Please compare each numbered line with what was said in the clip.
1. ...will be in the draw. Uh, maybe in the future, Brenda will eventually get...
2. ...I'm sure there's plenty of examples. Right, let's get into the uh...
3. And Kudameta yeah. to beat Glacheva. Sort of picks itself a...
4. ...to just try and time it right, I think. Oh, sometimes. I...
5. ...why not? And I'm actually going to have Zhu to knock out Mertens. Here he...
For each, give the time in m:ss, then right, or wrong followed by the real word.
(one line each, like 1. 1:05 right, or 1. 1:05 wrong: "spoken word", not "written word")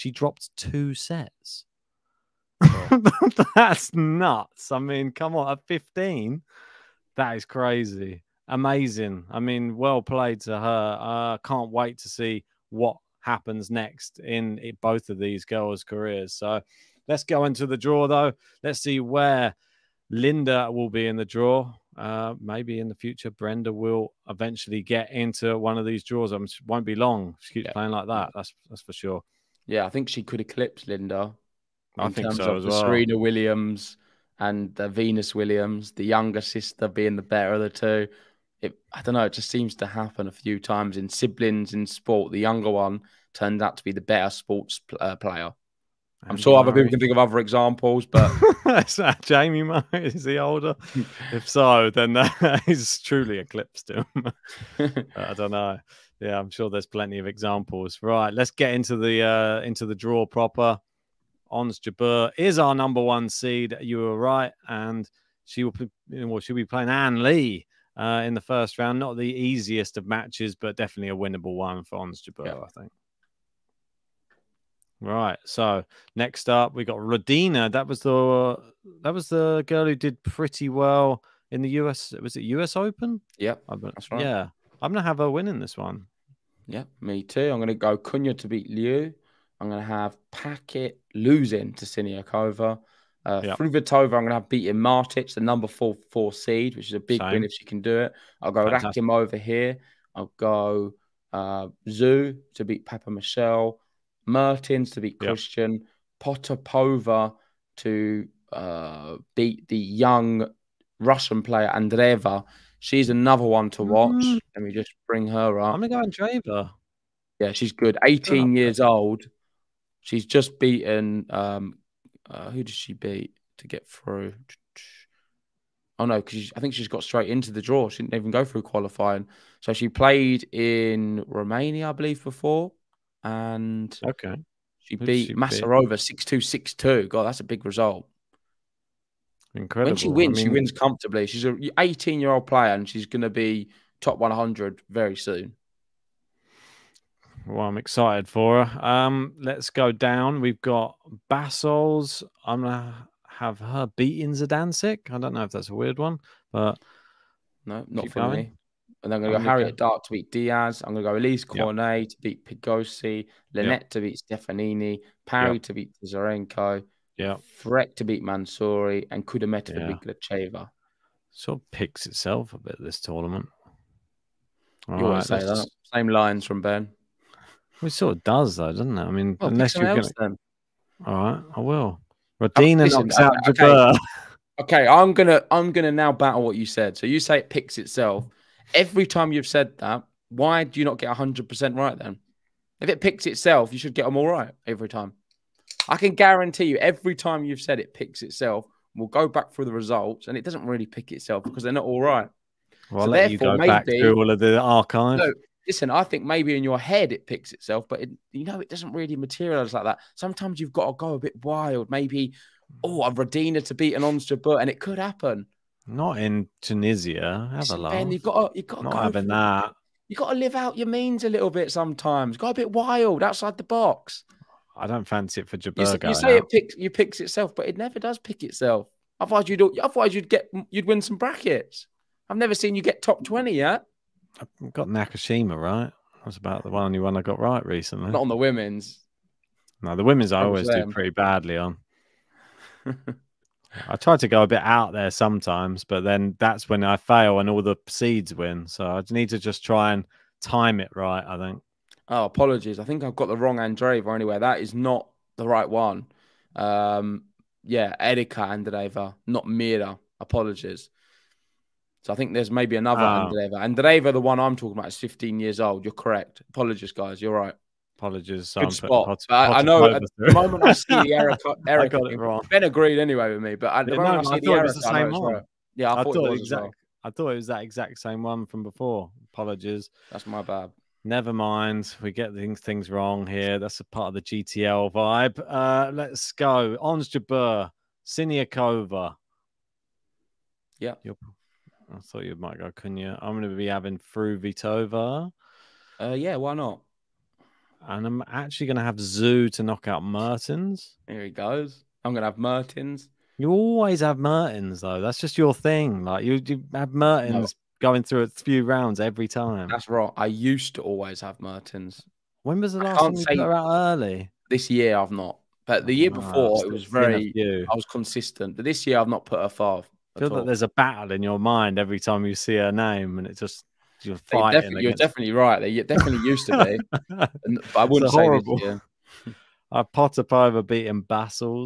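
1. 0:20 right
2. 0:56 right
3. 2:49 right
4. 4:09 wrong: "apologies", not "sometimes"
5. 4:56 right.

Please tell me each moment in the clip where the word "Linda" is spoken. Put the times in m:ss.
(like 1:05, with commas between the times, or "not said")
0:20, 0:30.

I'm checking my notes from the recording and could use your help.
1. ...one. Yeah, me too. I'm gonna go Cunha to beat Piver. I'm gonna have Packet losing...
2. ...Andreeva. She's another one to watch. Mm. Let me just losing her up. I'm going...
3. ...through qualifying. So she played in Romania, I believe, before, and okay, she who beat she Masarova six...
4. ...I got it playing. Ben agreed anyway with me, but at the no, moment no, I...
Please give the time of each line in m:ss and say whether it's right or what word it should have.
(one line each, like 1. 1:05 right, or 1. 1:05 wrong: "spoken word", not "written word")
1. 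1:25 wrong: "Liu", not "Piver"
2. 1:51 wrong: "bring", not "losing"
3. 2:08 right
4. 4:31 wrong: "wrong", not "playing".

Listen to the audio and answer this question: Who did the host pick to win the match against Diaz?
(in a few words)
Harriet Dart.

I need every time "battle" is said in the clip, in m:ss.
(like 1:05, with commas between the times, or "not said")
3:06, 5:20.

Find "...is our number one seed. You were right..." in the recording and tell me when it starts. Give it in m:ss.
1:02.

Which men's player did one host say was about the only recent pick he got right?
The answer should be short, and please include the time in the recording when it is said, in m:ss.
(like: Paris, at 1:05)
Nakashima, at 3:54.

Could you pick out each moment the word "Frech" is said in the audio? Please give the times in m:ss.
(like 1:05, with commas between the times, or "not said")
2:47.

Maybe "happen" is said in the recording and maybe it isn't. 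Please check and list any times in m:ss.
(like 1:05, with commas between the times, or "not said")
0:13, 0:39, 3:34.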